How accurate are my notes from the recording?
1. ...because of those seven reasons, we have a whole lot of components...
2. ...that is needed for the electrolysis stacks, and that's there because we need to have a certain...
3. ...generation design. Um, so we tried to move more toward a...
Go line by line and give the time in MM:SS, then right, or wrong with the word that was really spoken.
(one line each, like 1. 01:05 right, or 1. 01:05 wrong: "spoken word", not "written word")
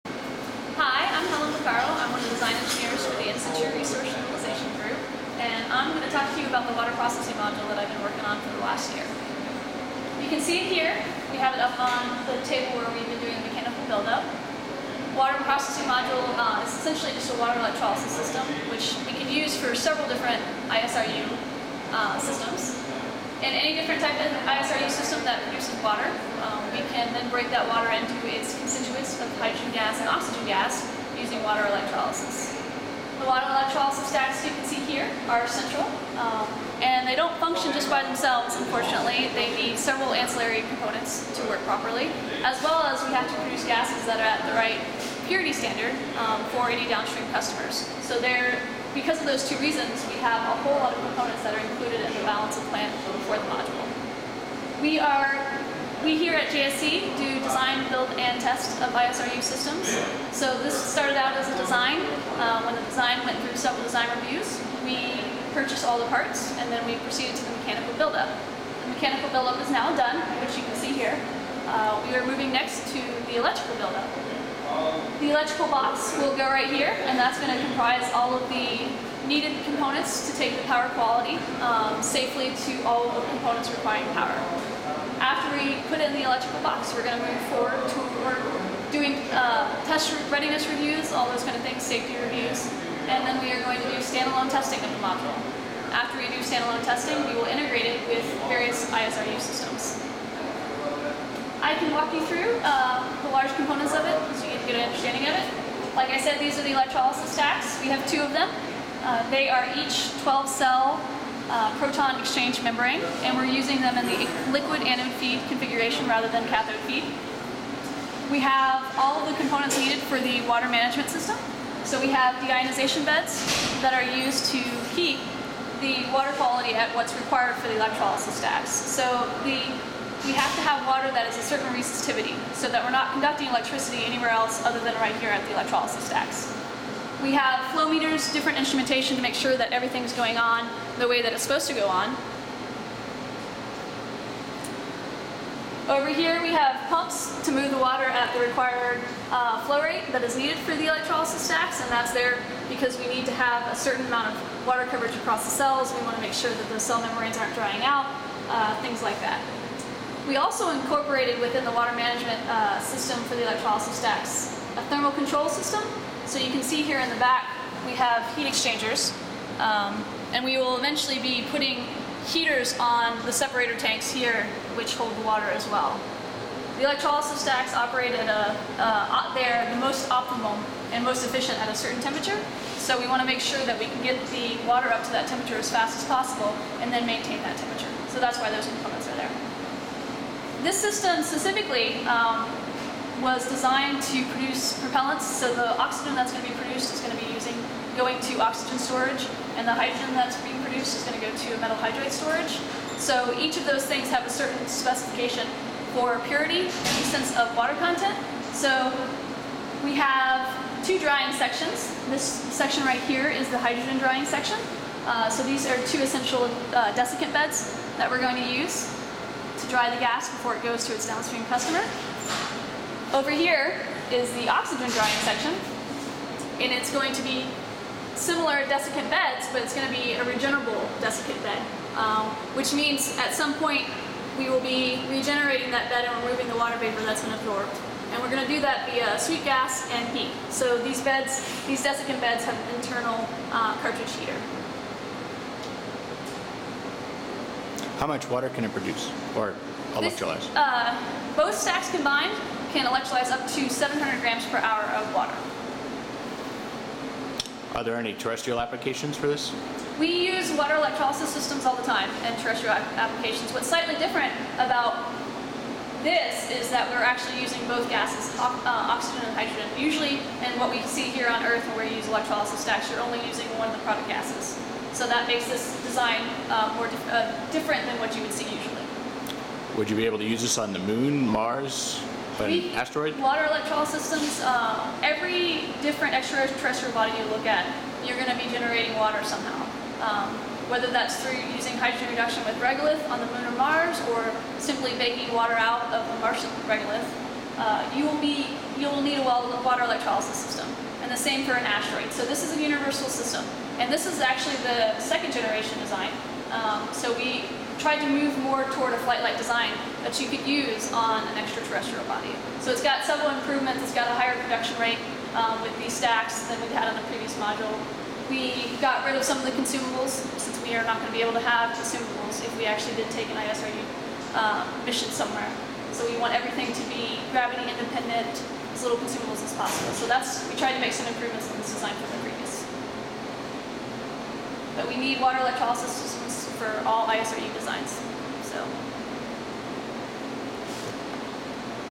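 1. 00:48 wrong: "two", not "seven"
2. 02:30 right
3. 05:05 right.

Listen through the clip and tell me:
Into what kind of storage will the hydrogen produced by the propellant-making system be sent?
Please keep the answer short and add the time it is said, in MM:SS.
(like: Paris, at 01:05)
metal hydride storage, at 03:21.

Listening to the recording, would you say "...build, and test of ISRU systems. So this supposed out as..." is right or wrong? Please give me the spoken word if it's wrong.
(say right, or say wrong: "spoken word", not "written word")
wrong: "started", not "supposed".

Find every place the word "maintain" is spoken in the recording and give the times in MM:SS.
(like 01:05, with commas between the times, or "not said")
03:07.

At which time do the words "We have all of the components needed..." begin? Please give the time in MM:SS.
01:58.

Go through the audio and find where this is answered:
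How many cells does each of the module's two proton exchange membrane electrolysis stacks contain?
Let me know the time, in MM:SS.
01:50.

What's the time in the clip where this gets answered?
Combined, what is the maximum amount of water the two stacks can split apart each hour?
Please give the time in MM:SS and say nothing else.
04:13.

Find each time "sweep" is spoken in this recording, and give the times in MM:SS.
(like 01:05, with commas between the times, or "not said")
03:59.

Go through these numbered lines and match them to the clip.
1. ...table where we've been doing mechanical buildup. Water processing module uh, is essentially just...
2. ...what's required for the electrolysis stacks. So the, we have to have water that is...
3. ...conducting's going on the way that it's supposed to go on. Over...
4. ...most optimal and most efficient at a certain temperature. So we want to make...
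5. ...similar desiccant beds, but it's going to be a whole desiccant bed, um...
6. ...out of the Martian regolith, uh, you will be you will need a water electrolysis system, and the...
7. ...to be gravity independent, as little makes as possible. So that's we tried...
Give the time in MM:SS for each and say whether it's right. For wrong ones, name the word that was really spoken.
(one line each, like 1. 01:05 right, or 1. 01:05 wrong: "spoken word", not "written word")
1. 00:12 right
2. 02:06 right
3. 02:19 wrong: "everything", not "conducting"
4. 02:59 right
5. 03:48 wrong: "regenerable", not "whole"
6. 04:55 right
7. 05:26 wrong: "consumables", not "makes".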